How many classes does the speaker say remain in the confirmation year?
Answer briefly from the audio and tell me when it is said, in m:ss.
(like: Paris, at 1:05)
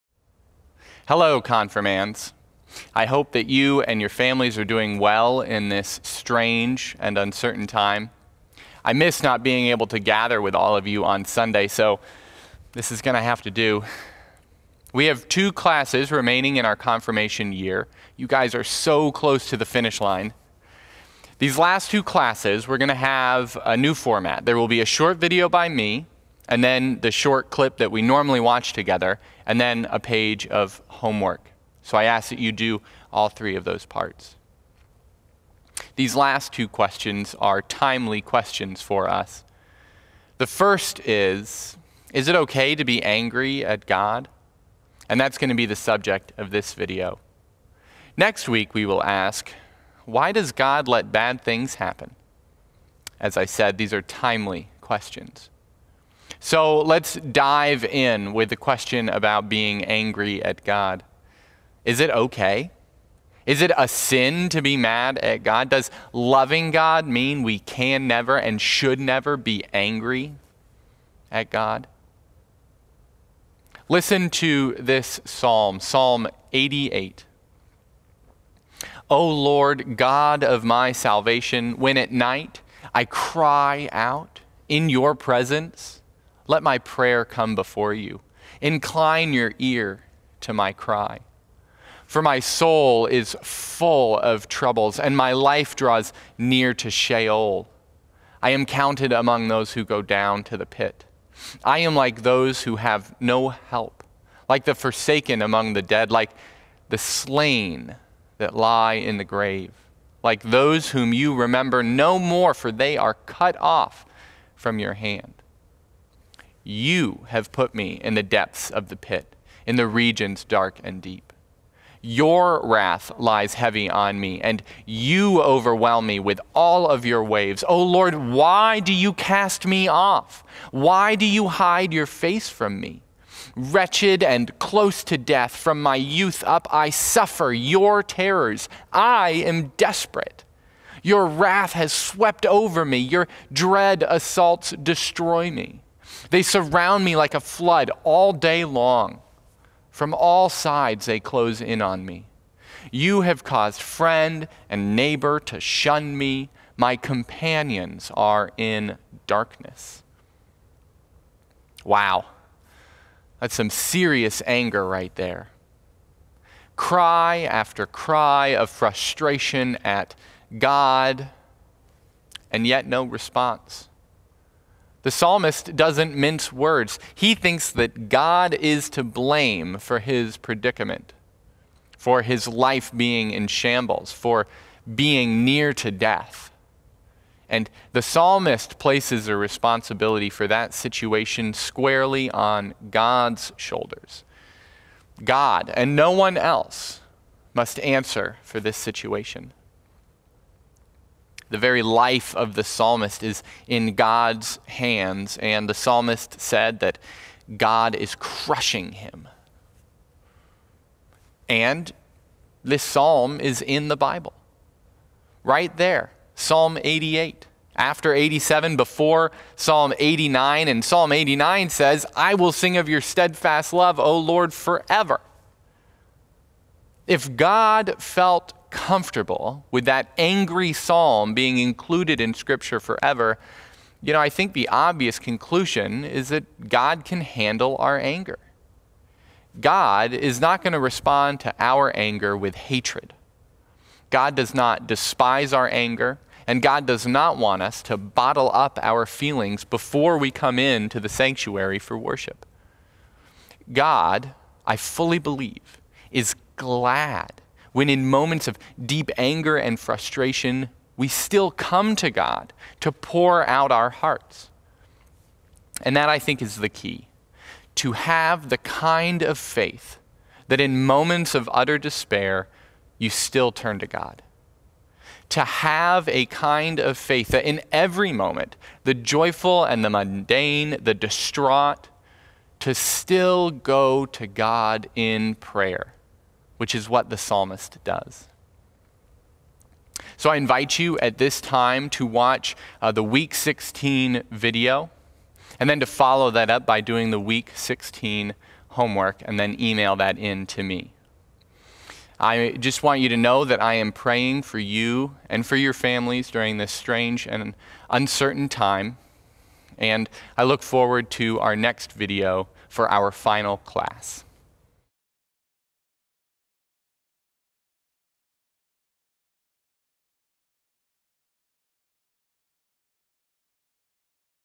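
2, at 0:15.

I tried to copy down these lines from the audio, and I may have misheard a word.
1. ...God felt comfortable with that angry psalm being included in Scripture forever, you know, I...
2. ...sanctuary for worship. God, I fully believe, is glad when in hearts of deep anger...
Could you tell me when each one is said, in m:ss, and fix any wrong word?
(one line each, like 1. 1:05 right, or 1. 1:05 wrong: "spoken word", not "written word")
1. 3:47 right
2. 4:11 wrong: "moments", not "hearts".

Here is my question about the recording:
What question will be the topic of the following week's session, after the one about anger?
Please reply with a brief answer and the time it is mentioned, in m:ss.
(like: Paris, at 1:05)
Why does God let bad things happen?, at 0:50.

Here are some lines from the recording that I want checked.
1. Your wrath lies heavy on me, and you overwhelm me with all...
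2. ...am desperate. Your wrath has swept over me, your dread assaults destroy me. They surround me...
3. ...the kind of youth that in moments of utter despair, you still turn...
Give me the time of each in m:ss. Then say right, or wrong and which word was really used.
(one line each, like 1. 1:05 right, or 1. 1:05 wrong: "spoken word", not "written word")
1. 2:02 right
2. 2:19 right
3. 4:28 wrong: "faith", not "youth".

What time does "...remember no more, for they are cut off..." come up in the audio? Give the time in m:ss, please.
1:51.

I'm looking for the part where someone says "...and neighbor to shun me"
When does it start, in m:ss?
2:34.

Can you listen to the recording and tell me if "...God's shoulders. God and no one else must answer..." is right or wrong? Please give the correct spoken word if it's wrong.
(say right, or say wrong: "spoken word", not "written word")
right.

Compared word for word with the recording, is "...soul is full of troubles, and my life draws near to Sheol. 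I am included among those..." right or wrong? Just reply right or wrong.
wrong.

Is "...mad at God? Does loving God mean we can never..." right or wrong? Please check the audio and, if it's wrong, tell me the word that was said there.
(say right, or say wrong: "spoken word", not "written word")
right.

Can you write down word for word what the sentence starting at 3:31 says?
And this psalm is in the Bible, right there.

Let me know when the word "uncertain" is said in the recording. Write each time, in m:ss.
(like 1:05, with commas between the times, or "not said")
0:07, 5:07.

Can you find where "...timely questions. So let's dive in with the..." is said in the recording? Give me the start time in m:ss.
0:54.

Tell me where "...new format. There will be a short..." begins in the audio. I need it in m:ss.
0:23.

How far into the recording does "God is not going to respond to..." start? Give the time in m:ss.
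3:59.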